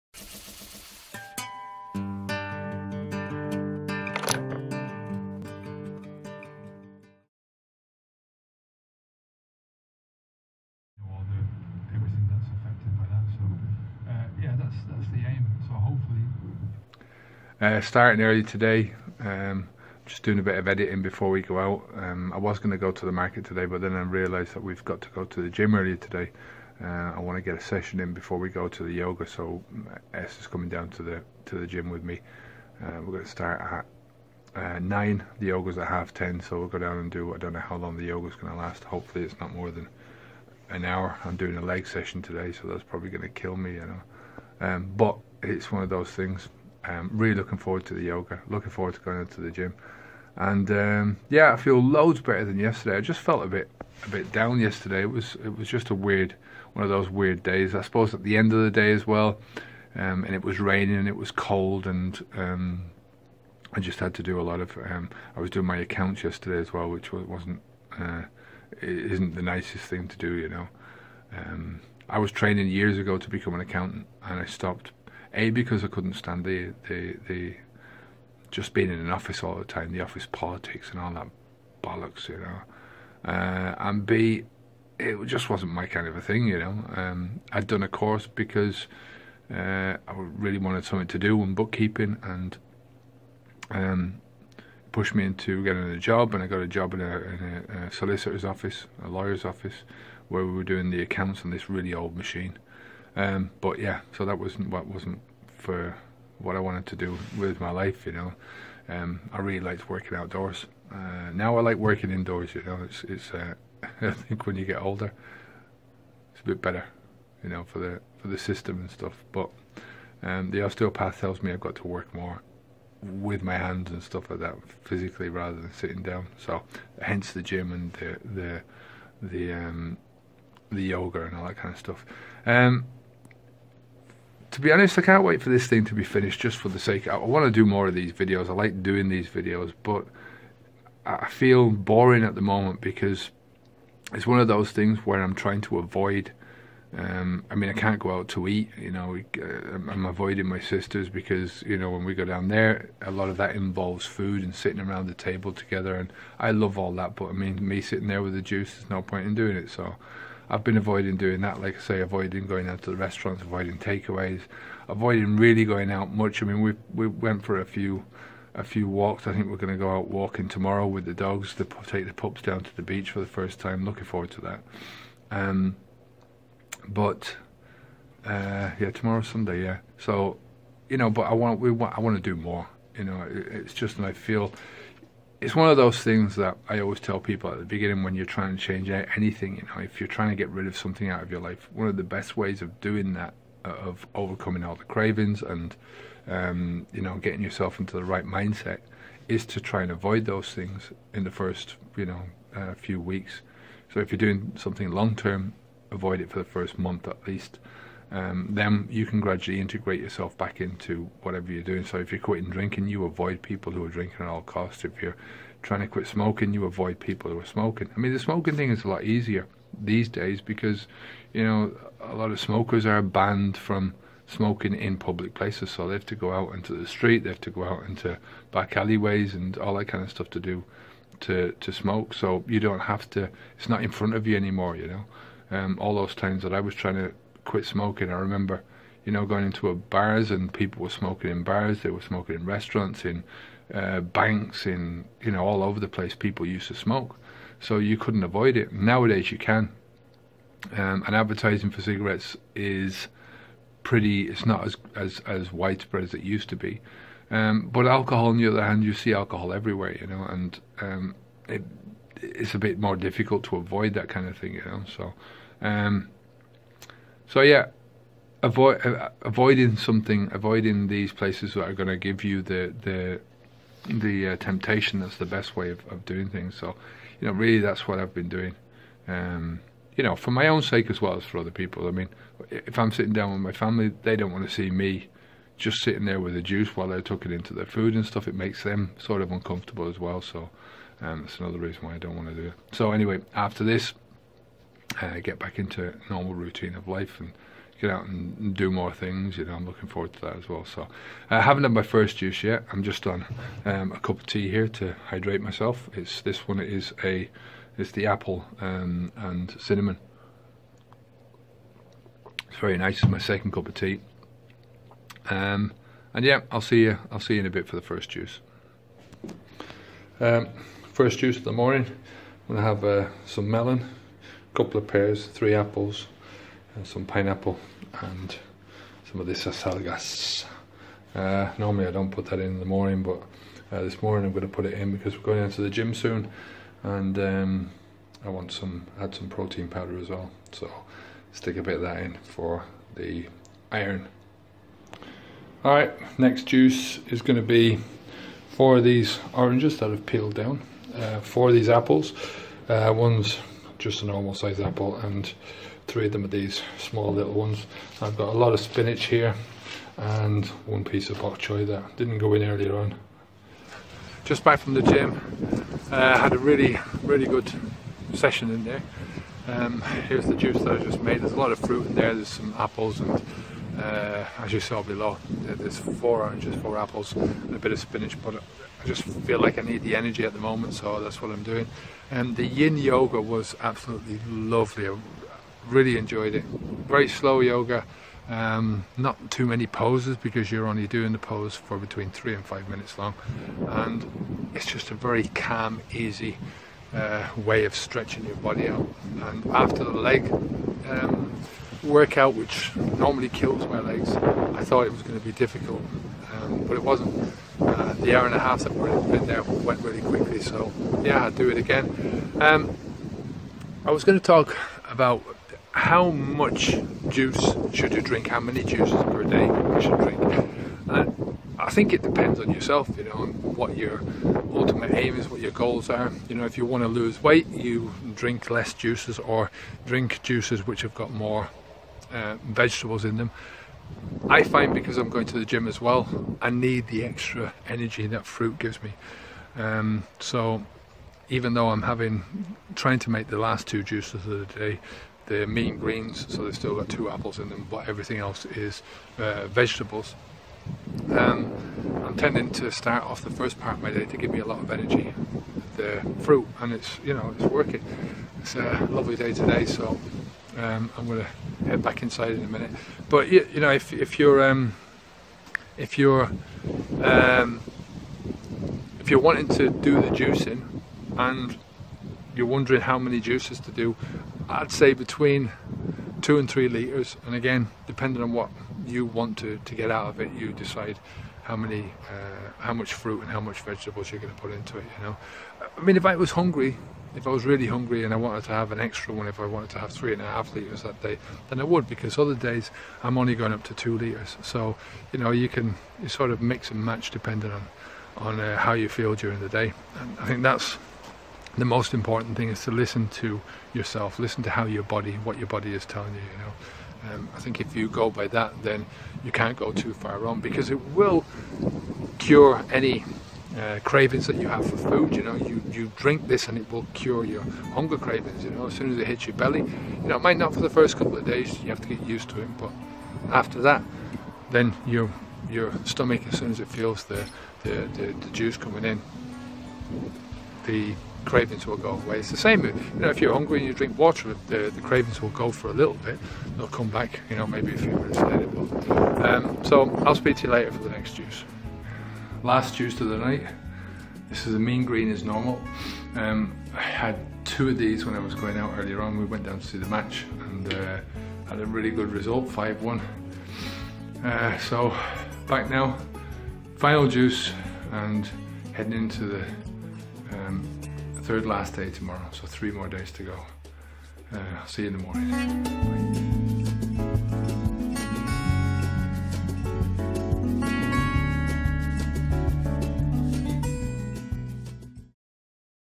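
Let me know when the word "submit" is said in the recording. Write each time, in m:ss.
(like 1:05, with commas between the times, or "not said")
not said.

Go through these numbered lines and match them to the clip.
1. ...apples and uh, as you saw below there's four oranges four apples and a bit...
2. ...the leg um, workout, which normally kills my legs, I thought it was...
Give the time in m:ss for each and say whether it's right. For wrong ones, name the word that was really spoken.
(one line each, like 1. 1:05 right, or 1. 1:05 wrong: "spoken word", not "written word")
1. 6:12 right
2. 6:39 right.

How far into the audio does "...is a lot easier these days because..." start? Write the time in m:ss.
3:38.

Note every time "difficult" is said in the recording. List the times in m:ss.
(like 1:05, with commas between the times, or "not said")
4:22, 6:45.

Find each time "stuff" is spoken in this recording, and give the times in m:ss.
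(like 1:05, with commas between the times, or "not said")
1:58, 2:04, 2:11, 3:50, 4:48.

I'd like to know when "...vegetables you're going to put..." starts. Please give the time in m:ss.
8:03.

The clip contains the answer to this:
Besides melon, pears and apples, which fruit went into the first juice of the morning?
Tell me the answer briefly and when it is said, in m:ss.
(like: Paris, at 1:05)
Pineapple, at 5:27.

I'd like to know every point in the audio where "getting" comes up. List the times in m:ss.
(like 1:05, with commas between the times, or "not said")
1:35, 3:17.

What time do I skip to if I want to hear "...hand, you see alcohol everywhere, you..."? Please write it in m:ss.
4:18.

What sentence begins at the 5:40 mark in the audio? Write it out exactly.
So stick a bit of that in for the iron.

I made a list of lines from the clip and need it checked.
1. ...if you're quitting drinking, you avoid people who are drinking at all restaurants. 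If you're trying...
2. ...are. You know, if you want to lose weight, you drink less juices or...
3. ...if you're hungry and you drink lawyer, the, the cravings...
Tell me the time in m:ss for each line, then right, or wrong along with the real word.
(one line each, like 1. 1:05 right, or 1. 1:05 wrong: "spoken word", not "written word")
1. 3:31 wrong: "costs", not "restaurants"
2. 7:05 right
3. 8:53 wrong: "water", not "lawyer".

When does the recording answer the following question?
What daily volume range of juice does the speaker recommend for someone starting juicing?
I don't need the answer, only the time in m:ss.
7:56.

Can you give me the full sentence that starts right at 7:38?
It's a lovely day today, so um, I'm going to head back inside in a minute.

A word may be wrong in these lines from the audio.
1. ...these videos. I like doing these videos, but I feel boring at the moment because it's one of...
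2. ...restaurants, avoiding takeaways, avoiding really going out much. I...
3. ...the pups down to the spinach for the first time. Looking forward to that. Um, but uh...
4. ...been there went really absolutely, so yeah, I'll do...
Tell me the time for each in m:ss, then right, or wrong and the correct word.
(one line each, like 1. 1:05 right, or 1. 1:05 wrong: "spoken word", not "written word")
1. 2:17 right
2. 2:42 right
3. 2:52 wrong: "beach", not "spinach"
4. 6:49 wrong: "quickly", not "absolutely".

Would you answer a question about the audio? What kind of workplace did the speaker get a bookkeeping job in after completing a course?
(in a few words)
A solicitor's office.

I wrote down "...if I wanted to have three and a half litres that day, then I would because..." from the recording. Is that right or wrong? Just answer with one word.
right.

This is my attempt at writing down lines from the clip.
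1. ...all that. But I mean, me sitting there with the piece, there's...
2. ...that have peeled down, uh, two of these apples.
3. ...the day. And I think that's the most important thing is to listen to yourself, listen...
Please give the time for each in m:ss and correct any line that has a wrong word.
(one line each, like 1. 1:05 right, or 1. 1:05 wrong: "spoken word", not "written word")
1. 2:36 wrong: "juice", not "piece"
2. 5:49 wrong: "four", not "two"
3. 8:19 right.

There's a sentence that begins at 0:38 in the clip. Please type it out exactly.
Hopefully, it's not more than an hour.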